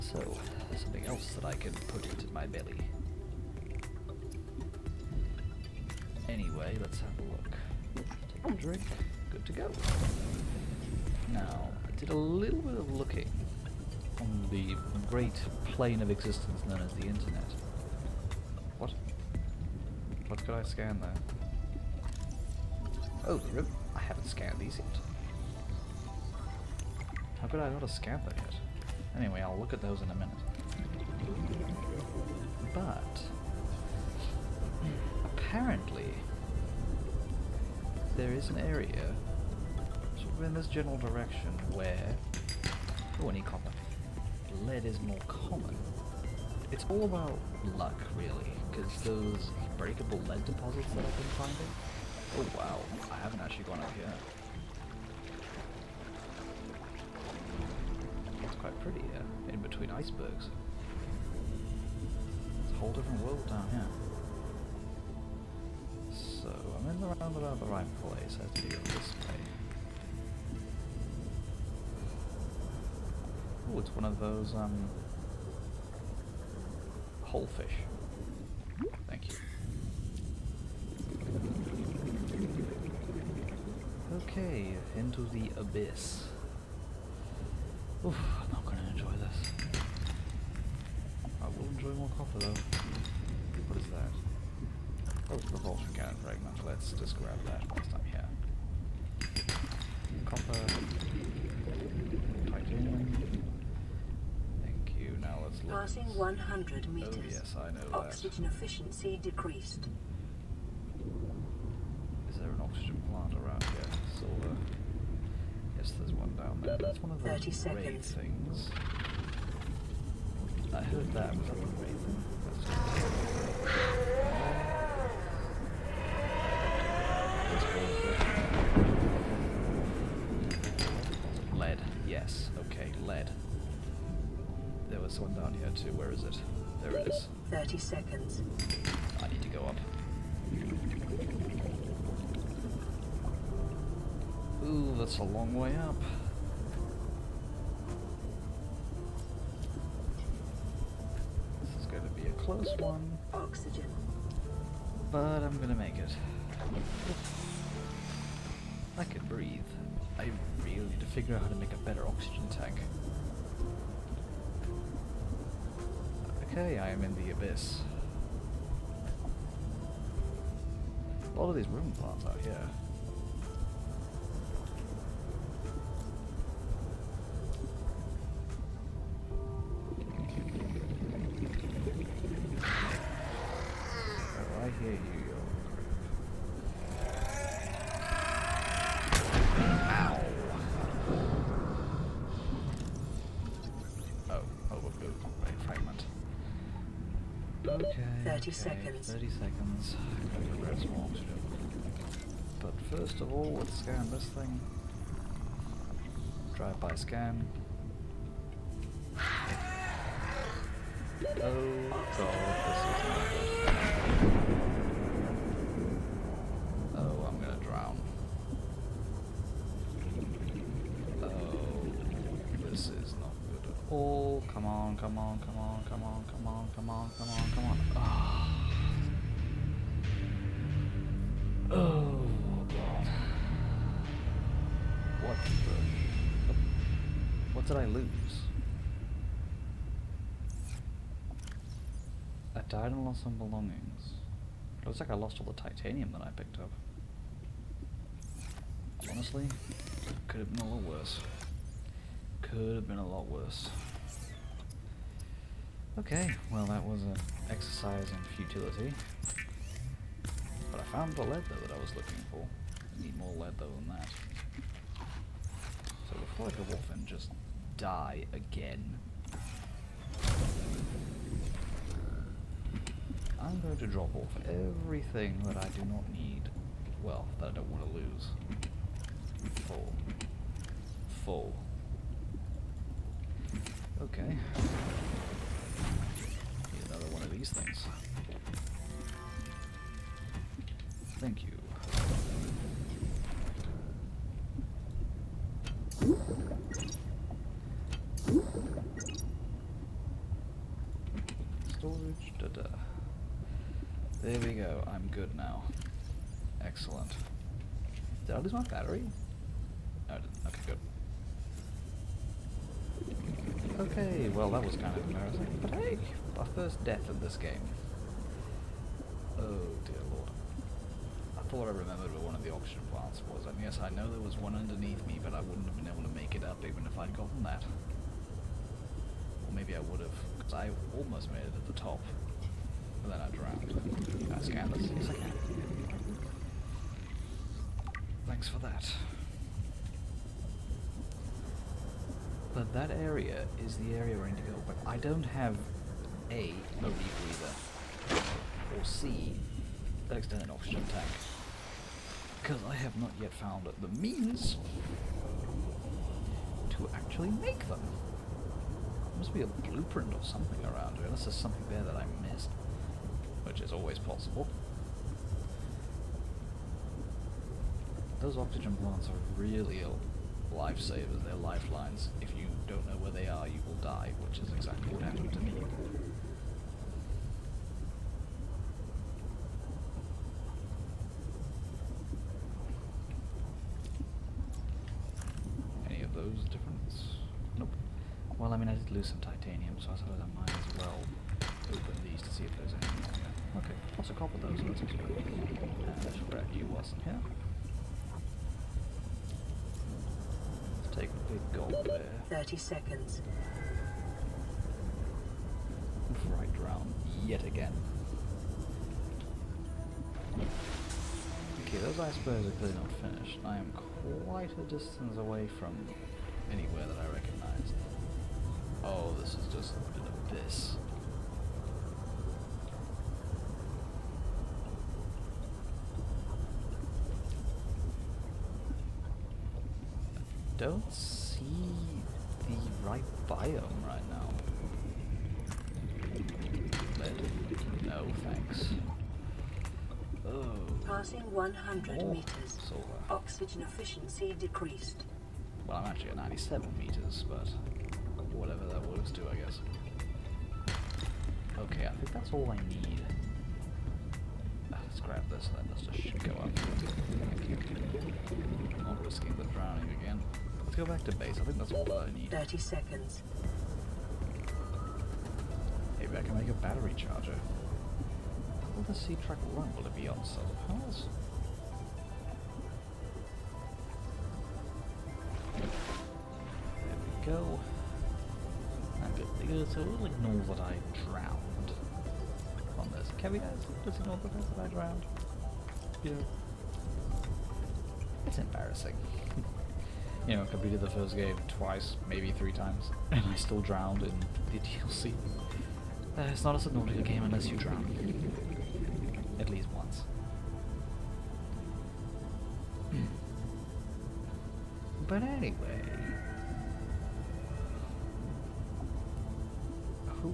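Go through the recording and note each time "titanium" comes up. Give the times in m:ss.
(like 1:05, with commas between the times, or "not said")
4:05, 6:29.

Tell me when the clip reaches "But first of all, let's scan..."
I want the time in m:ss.
3:22.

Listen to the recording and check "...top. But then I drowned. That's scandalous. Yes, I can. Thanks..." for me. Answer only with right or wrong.
right.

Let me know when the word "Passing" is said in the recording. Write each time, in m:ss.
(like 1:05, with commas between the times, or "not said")
1:45, 7:20.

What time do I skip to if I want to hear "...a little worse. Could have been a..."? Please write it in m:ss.
4:10.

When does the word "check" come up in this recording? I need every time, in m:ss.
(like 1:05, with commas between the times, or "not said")
not said.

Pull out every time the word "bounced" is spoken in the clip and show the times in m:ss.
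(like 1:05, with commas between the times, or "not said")
not said.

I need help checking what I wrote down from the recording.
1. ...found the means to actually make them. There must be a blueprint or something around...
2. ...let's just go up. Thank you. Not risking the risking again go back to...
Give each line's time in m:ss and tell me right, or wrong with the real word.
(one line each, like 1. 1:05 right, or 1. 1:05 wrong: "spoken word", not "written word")
1. 5:53 right
2. 7:35 wrong: "drowning", not "risking".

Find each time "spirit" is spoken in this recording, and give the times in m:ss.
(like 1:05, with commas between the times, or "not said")
not said.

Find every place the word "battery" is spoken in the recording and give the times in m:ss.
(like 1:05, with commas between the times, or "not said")
5:08, 7:46.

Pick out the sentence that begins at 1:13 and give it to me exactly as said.
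Oh, it's one of those, um, whole fish.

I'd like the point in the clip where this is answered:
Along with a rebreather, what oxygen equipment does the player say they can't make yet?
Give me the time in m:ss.
5:50.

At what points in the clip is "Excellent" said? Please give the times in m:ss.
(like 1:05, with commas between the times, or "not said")
5:06.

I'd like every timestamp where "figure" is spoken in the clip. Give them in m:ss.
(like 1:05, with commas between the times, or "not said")
2:41.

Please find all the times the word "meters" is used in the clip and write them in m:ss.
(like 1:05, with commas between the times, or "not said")
1:46, 7:22, 7:26.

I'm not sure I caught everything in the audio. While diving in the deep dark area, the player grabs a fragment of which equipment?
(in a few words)
repulsion cannon.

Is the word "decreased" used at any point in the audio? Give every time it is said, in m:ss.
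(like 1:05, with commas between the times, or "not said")
1:49, 7:24.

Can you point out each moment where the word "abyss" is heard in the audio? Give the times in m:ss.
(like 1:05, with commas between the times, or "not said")
1:25, 2:47, 7:00.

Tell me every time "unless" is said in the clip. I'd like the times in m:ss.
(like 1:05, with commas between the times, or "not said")
6:01, 8:17.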